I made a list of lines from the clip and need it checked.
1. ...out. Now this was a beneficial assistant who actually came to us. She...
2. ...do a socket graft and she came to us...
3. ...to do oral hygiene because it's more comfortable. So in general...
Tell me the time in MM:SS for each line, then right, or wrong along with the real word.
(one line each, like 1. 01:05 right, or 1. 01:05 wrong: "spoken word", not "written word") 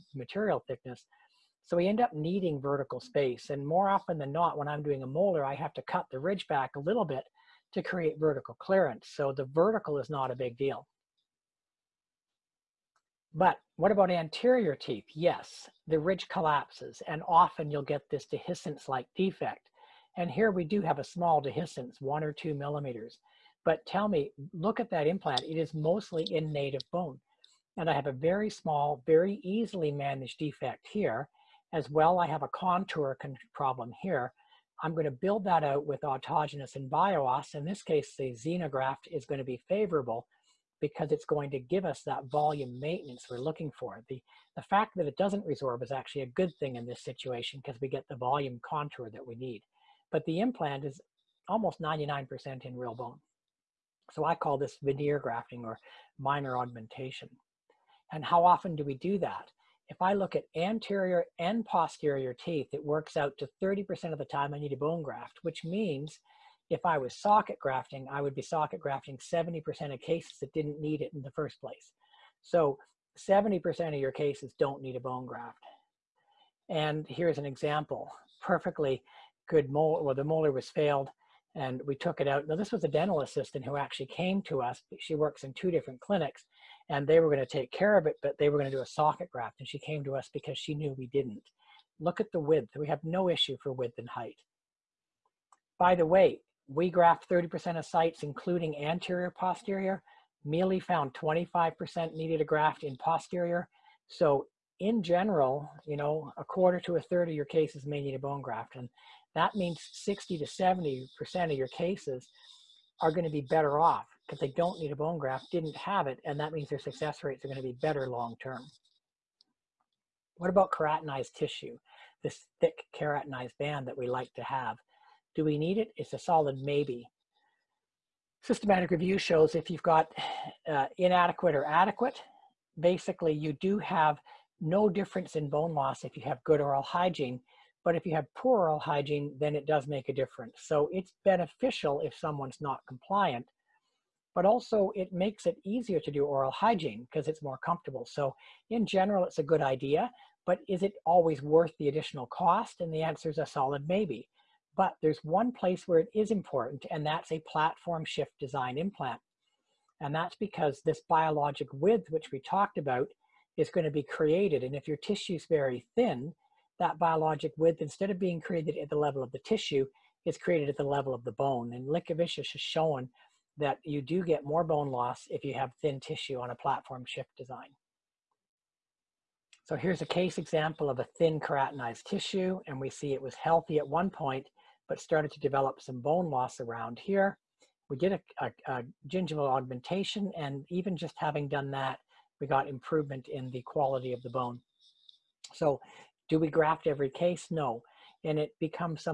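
1. 01:22 wrong: "dental", not "beneficial"
2. 01:28 right
3. 02:25 right.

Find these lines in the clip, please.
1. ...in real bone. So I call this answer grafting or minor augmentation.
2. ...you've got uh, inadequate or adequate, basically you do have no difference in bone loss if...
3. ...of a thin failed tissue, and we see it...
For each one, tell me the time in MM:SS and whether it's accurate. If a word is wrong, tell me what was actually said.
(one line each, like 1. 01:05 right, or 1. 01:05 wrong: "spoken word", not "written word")
1. 00:52 wrong: "veneer", not "answer"
2. 02:09 right
3. 03:00 wrong: "keratinized", not "failed".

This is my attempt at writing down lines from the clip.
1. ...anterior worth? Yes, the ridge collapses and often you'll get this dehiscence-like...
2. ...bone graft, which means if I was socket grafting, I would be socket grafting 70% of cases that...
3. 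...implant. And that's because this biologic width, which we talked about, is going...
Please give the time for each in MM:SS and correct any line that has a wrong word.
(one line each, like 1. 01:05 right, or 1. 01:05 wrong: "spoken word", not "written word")
1. 00:14 wrong: "teeth", not "worth"
2. 01:04 right
3. 02:38 right.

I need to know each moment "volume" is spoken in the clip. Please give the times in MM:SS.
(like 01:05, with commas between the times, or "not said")
00:42, 00:48.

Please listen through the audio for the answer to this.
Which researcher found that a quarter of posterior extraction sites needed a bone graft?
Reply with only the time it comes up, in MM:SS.
01:40.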